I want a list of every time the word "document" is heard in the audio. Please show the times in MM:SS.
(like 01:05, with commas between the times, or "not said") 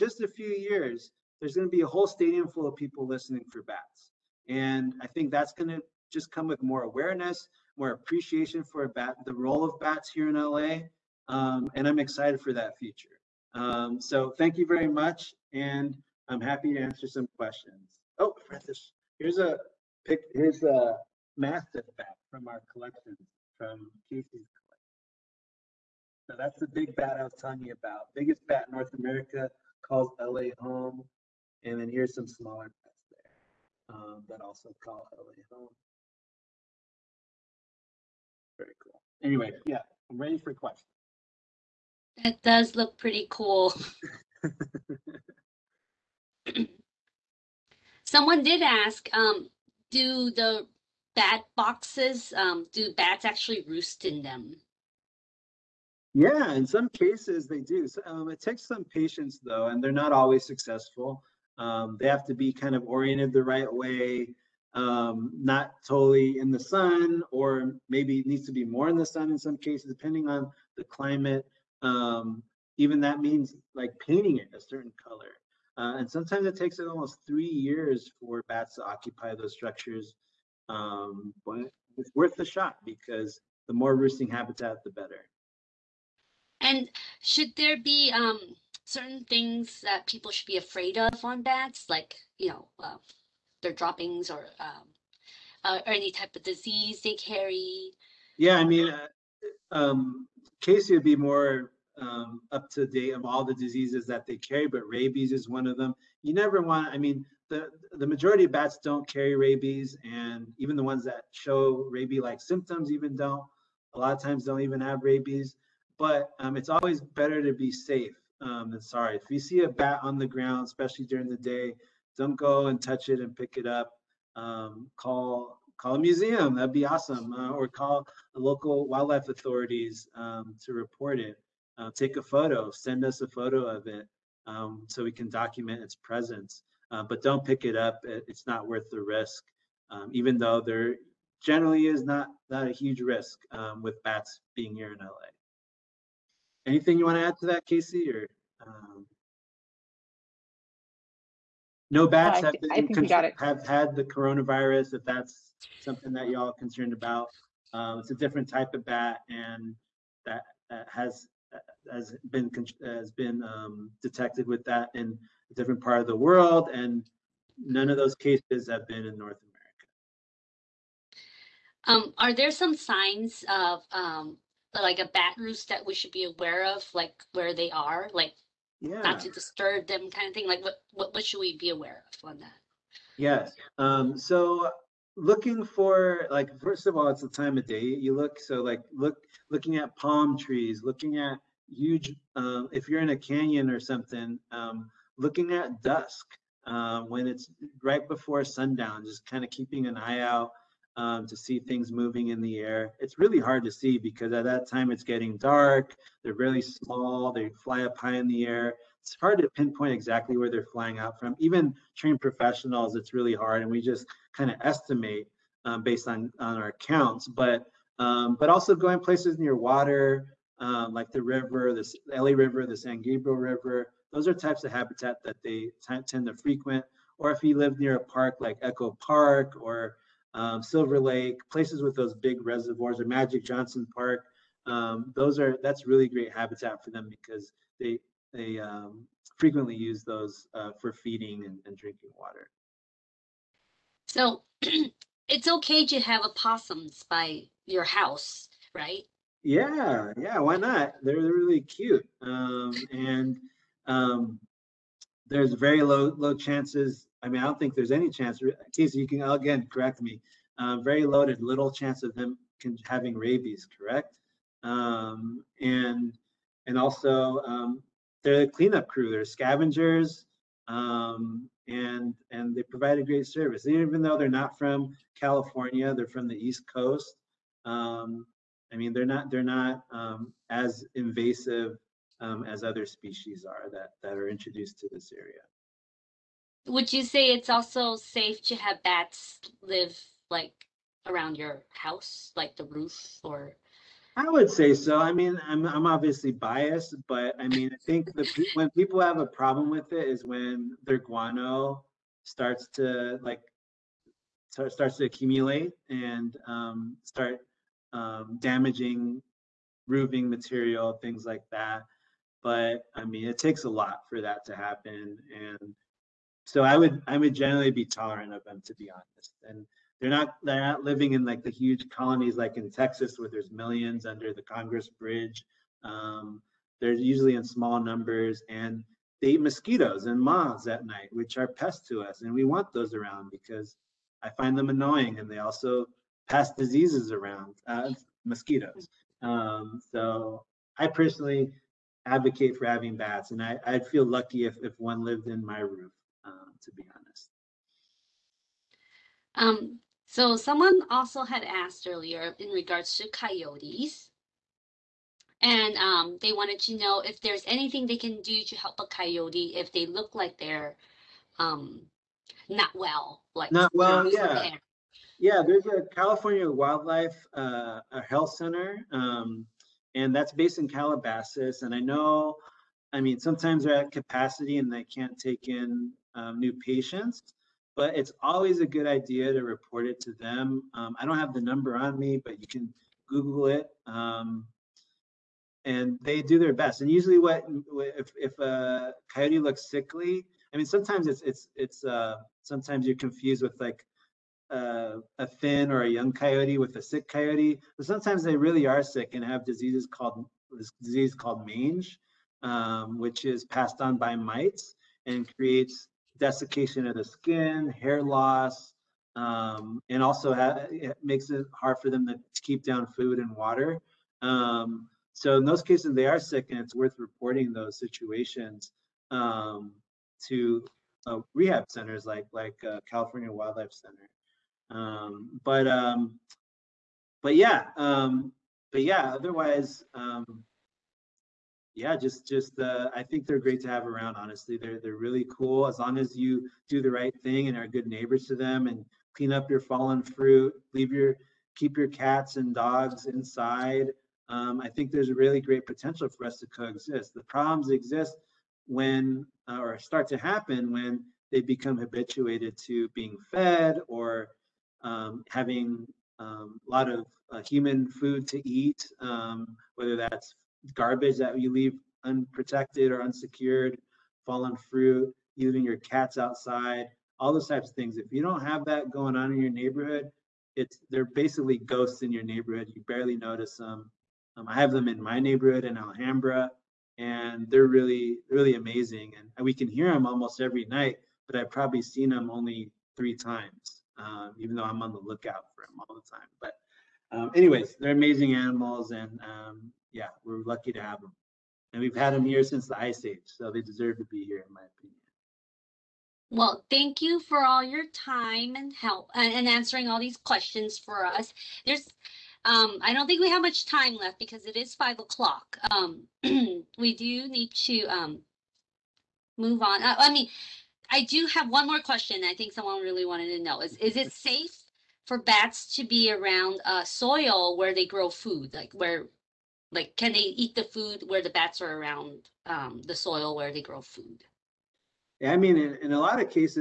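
02:15.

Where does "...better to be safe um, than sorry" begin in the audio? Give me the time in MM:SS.
01:56.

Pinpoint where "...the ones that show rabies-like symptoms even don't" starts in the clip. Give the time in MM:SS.
01:50.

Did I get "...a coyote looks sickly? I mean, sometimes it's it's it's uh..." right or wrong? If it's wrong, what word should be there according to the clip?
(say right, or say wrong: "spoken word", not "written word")
right.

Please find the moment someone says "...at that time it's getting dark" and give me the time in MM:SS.
03:24.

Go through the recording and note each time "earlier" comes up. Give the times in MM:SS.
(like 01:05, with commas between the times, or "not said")
05:51.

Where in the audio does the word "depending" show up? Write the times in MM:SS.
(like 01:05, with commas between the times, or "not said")
01:09.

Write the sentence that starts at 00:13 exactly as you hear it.
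Um, so thank you very much.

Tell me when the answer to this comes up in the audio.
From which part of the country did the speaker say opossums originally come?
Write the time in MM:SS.
04:36.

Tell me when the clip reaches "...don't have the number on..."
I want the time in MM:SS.
06:21.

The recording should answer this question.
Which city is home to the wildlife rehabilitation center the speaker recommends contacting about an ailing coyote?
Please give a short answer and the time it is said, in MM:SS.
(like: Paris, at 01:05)
Calabasas, at 06:10.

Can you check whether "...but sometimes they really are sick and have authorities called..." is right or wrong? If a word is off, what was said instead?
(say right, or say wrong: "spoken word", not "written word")
wrong: "diseases", not "authorities".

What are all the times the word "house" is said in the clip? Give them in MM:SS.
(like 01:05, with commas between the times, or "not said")
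04:07, 04:51.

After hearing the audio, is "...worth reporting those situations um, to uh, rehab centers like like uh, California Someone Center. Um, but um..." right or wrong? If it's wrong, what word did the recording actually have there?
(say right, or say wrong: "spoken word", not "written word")
wrong: "Wildlife", not "Someone".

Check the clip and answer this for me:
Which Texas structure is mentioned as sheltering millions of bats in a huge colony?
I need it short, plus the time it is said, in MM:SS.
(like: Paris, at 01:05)
Congress Bridge, at 05:24.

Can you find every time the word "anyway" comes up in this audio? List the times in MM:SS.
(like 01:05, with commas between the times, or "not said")
00:39, 08:07.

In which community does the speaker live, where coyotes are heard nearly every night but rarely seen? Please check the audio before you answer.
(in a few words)
Alhambra.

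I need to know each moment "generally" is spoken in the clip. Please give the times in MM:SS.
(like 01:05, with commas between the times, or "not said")
02:21, 05:17.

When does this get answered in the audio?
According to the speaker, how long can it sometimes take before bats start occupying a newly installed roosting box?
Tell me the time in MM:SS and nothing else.
01:17.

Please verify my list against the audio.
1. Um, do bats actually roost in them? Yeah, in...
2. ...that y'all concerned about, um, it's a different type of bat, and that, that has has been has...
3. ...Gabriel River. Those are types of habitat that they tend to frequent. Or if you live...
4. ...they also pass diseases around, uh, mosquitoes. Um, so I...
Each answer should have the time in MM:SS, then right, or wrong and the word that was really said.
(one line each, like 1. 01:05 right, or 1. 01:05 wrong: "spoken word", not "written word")
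1. 00:52 right
2. 02:36 right
3. 03:42 right
4. 05:35 right.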